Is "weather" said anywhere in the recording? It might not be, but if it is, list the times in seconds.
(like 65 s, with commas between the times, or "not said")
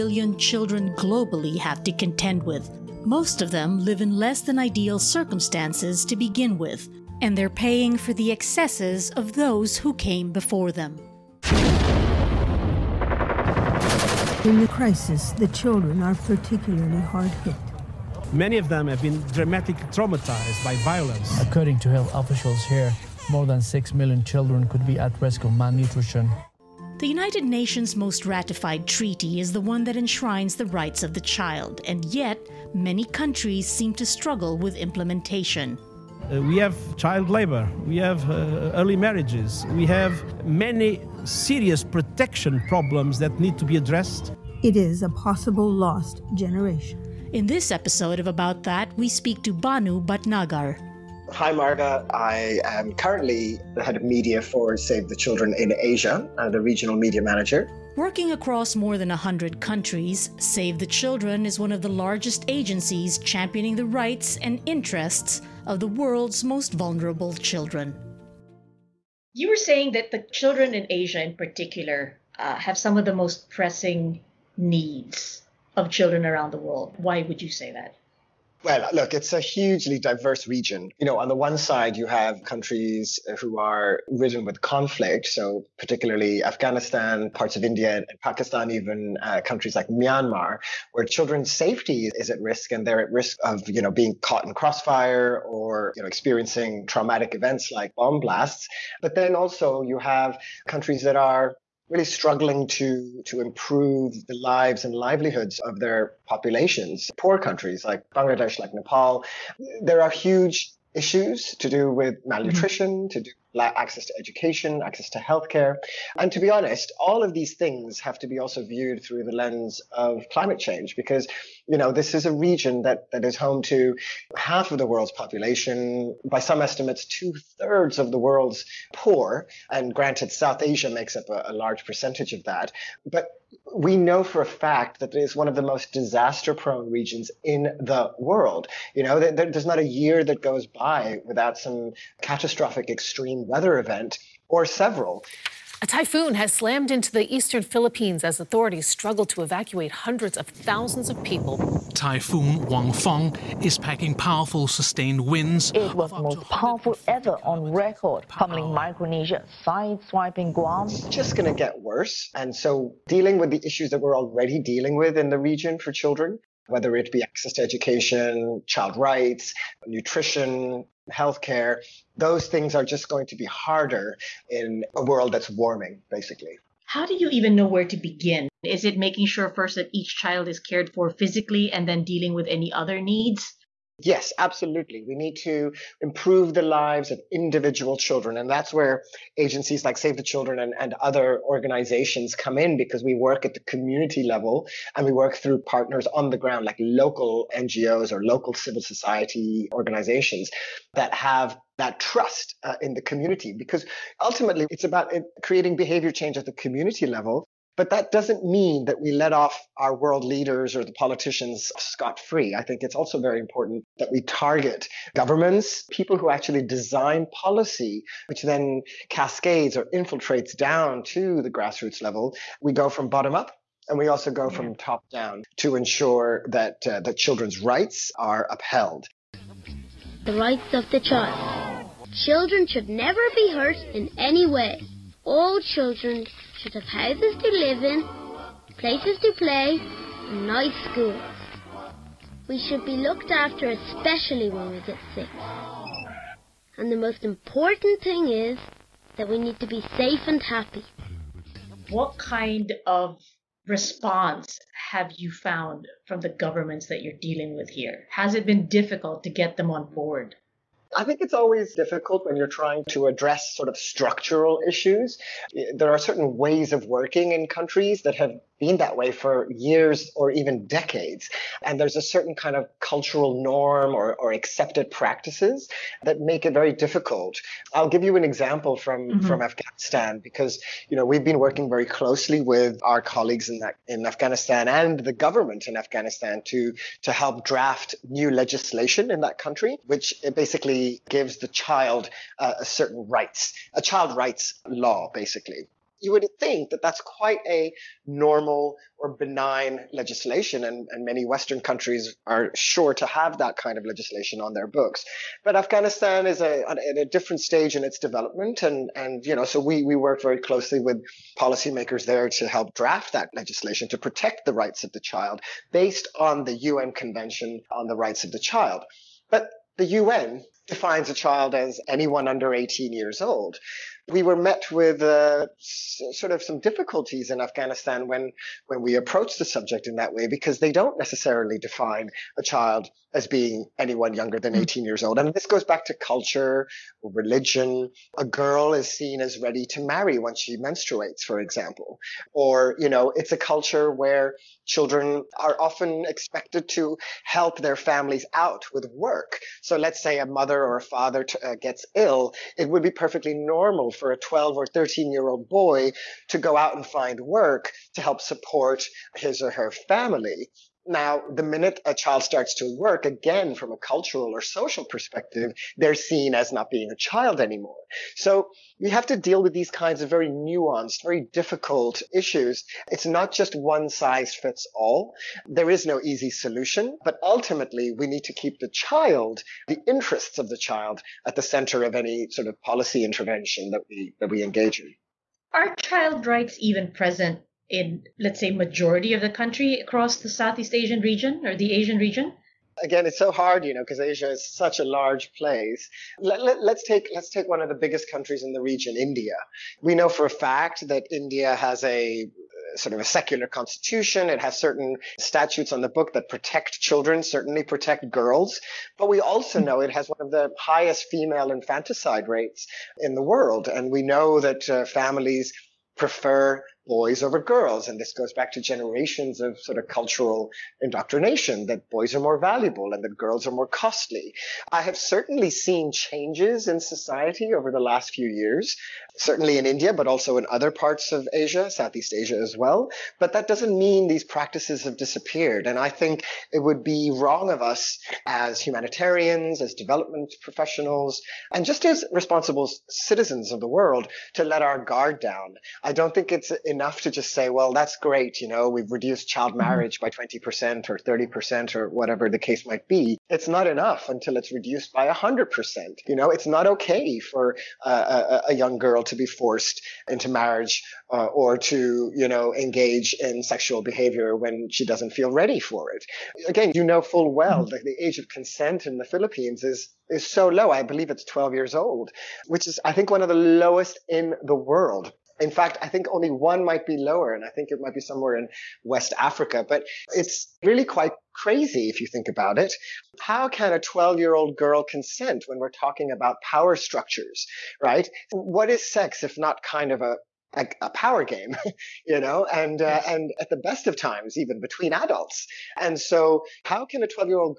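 143 s.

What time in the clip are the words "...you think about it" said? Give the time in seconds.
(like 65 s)
481 s.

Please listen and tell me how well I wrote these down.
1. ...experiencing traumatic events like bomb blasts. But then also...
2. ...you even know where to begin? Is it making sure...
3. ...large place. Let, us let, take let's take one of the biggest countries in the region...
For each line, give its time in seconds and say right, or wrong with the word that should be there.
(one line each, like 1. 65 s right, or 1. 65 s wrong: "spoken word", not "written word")
1. 96 s right
2. 177 s right
3. 394 s right.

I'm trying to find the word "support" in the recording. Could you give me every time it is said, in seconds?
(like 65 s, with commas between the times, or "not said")
358 s.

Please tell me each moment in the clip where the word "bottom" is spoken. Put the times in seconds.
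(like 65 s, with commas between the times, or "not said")
223 s.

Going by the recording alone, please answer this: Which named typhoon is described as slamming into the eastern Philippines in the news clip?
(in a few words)
Typhoon Fong.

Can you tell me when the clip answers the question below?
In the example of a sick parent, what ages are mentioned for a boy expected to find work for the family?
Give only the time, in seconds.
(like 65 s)
354 s.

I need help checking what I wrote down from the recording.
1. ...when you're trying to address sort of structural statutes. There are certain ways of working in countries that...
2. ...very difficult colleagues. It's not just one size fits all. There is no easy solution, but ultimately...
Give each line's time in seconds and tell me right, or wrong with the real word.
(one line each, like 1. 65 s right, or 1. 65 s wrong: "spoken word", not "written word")
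1. 262 s wrong: "issues", not "statutes"
2. 371 s wrong: "issues", not "colleagues".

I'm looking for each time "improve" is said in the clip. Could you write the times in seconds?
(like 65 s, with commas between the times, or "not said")
103 s, 185 s.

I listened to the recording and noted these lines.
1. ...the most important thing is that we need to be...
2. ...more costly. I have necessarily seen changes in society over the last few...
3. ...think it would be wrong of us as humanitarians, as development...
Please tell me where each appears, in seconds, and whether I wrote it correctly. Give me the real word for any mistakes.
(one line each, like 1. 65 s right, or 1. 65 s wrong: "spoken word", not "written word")
1. 246 s right
2. 423 s wrong: "certainly", not "necessarily"
3. 435 s right.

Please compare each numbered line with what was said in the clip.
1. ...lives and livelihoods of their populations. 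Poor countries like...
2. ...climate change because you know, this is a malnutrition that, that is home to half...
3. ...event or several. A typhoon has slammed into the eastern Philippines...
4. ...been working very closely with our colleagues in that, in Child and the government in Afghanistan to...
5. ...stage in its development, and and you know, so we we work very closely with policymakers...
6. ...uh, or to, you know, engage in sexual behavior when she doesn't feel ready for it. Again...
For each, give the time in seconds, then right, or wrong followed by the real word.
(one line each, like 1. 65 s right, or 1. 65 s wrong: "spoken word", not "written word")
1. 104 s right
2. 120 s wrong: "region", not "malnutrition"
3. 143 s right
4. 281 s wrong: "Afghanistan", not "Child"
5. 307 s right
6. 461 s right.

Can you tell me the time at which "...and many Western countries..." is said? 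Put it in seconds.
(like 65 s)
300 s.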